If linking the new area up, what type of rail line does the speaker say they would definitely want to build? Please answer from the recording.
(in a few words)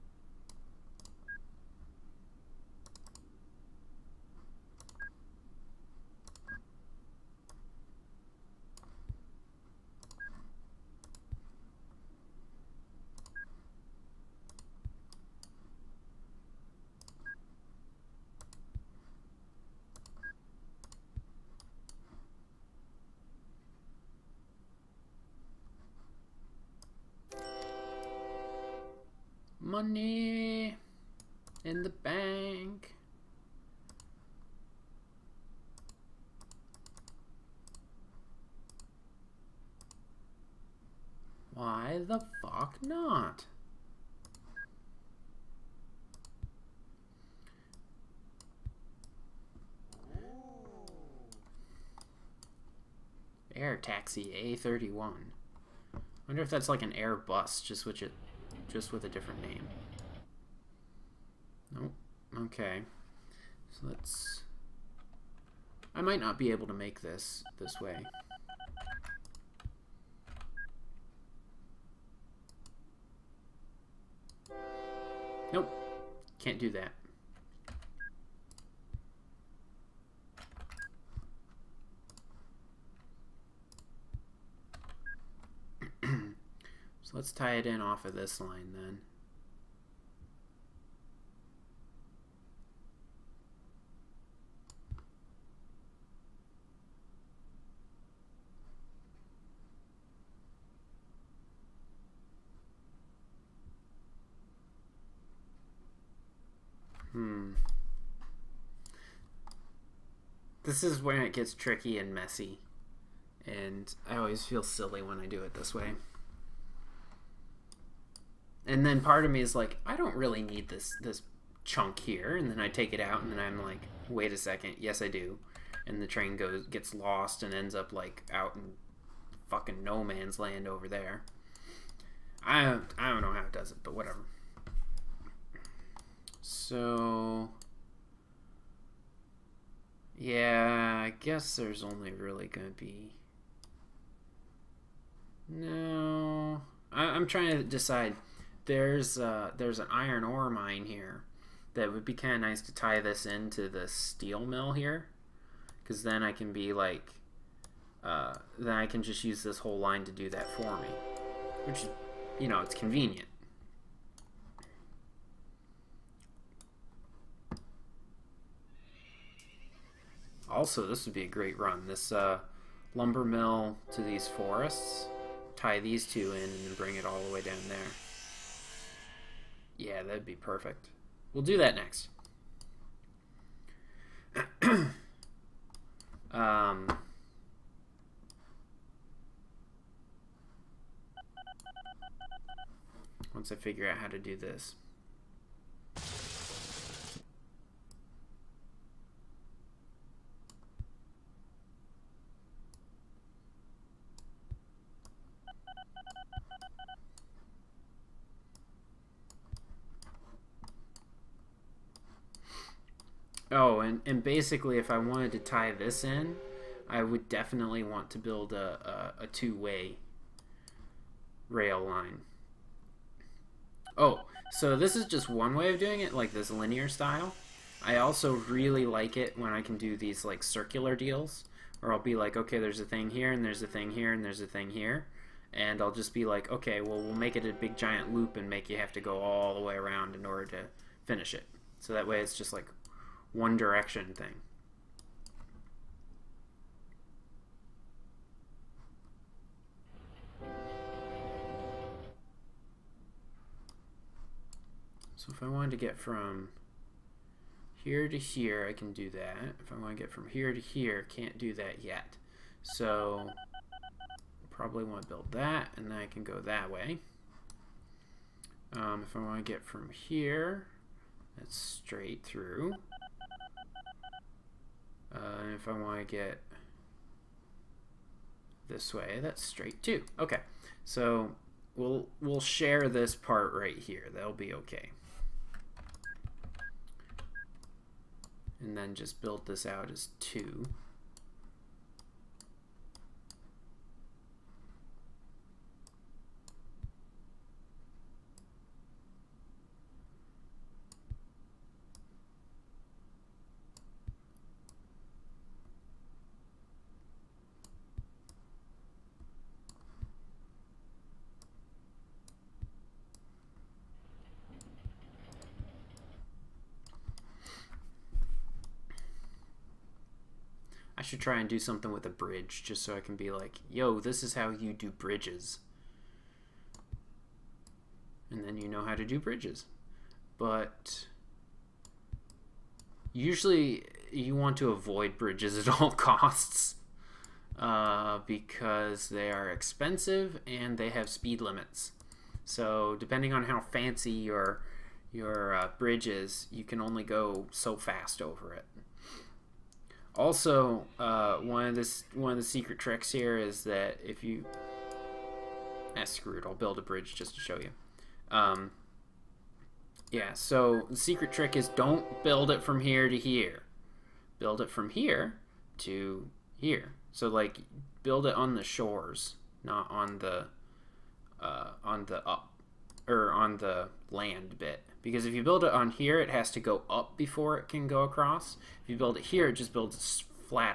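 two-way rail line.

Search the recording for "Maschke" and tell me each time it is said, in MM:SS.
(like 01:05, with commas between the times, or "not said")
not said.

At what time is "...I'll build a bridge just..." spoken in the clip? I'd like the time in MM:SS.
05:56.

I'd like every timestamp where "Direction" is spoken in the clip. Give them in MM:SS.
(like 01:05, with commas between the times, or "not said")
04:03.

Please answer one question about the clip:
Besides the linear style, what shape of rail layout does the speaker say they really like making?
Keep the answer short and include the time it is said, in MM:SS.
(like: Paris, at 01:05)
circular, at 03:50.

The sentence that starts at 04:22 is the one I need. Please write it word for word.
So probably want to build that, and then I can go that way.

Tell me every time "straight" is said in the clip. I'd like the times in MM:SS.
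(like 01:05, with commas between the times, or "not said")
04:31, 04:39.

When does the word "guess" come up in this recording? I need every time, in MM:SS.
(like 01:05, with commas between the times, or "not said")
02:21.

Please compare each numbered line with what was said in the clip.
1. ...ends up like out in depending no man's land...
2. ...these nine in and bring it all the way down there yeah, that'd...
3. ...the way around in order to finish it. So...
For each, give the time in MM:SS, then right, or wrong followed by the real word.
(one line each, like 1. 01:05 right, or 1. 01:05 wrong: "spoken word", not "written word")
1. 02:07 wrong: "fucking", not "depending"
2. 02:55 wrong: "two", not "nine"
3. 03:59 right.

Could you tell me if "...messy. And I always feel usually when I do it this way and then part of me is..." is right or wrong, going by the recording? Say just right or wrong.
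wrong.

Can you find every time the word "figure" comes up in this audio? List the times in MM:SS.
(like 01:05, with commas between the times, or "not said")
03:13.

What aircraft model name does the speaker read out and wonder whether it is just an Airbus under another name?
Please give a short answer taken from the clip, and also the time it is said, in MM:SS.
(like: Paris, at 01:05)
Patsy A31, at 00:54.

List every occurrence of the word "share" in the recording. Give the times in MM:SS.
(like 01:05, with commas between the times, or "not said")
04:42.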